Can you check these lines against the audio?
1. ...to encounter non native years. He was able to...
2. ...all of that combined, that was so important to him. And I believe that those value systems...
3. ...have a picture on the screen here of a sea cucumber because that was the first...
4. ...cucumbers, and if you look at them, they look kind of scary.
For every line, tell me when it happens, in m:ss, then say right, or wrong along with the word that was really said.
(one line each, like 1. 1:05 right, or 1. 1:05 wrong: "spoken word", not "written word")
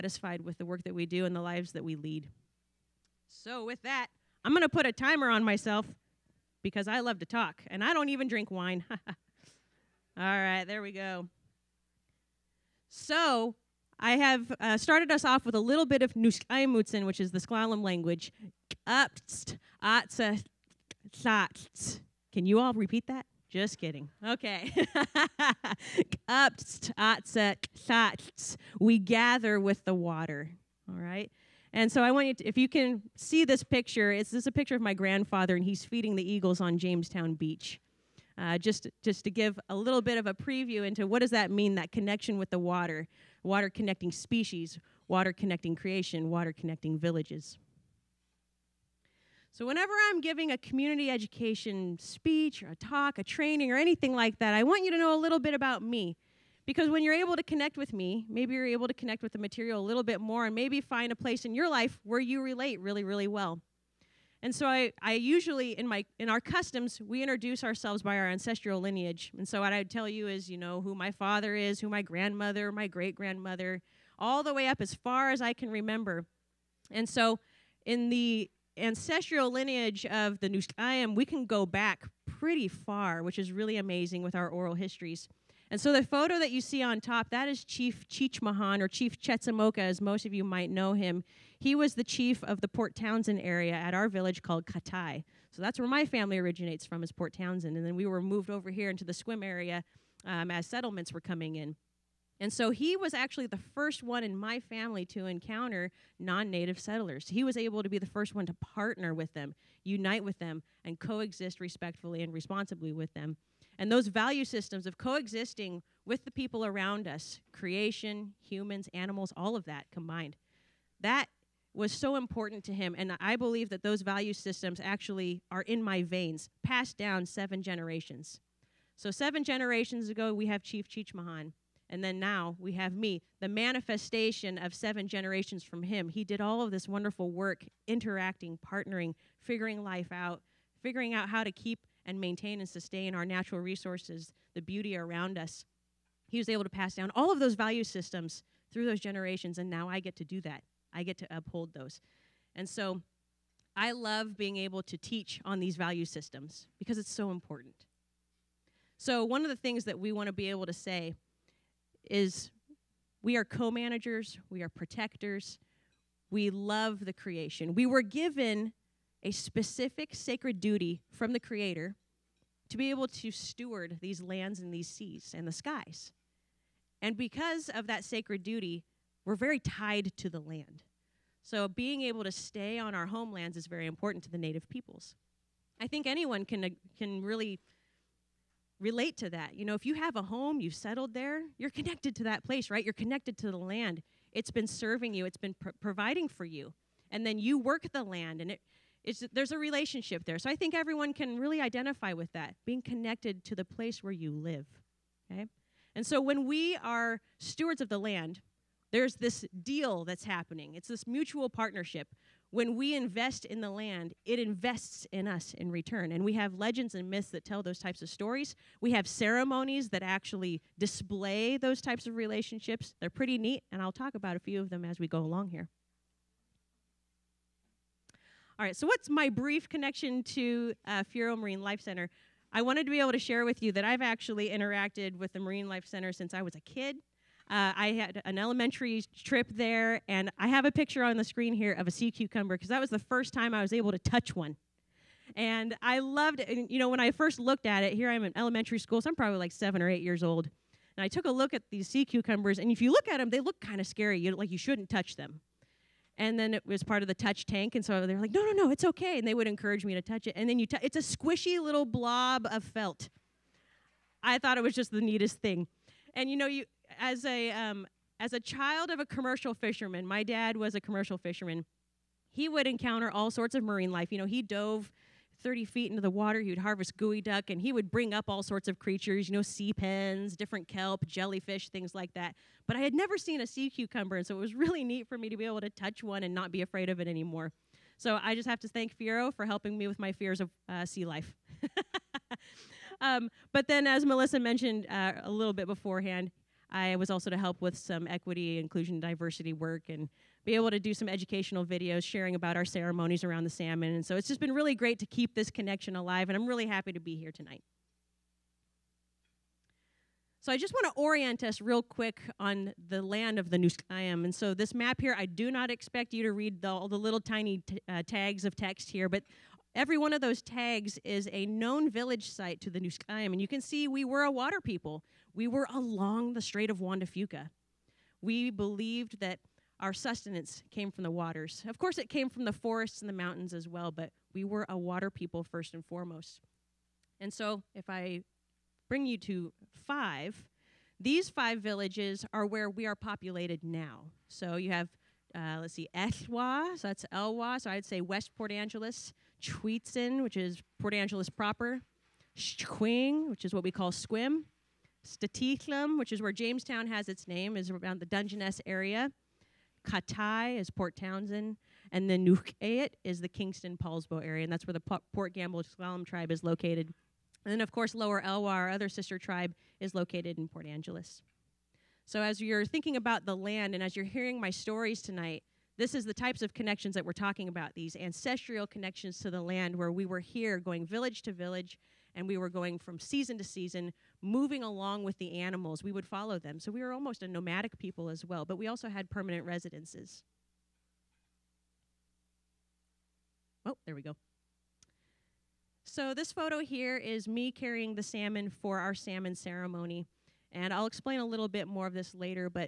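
1. 1:45 wrong: "settlers", not "years"
2. 1:59 right
3. 4:00 right
4. 4:12 right.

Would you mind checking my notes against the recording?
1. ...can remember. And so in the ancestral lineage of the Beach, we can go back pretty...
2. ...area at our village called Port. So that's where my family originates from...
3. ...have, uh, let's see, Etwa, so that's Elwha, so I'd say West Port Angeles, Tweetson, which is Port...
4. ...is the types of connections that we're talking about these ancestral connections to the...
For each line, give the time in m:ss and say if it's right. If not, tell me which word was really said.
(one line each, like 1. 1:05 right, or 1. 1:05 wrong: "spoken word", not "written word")
1. 1:15 wrong: "Nuskayam", not "Beach"
2. 1:33 wrong: "Katai", not "Port"
3. 5:44 right
4. 6:15 right.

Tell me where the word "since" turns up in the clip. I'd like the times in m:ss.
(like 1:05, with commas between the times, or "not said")
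3:56.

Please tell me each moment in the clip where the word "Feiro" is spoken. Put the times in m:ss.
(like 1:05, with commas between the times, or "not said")
3:51, 4:48.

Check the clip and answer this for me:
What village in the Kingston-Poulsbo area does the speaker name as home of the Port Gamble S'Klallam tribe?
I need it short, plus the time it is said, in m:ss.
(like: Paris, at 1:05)
Nukayet, at 6:02.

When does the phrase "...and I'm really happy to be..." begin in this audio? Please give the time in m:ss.
5:06.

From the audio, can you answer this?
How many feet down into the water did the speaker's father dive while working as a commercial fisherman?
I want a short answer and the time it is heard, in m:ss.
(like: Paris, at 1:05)
30, at 4:35.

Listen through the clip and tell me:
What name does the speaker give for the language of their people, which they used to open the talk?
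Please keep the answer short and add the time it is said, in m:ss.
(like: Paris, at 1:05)
Nuskaimutsen, at 0:16.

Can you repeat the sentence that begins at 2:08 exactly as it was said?
So, seven generations ago, we have Chief Cheech Mahan.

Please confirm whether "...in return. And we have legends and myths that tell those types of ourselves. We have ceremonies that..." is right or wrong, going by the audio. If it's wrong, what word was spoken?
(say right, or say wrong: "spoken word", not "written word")
wrong: "stories", not "ourselves".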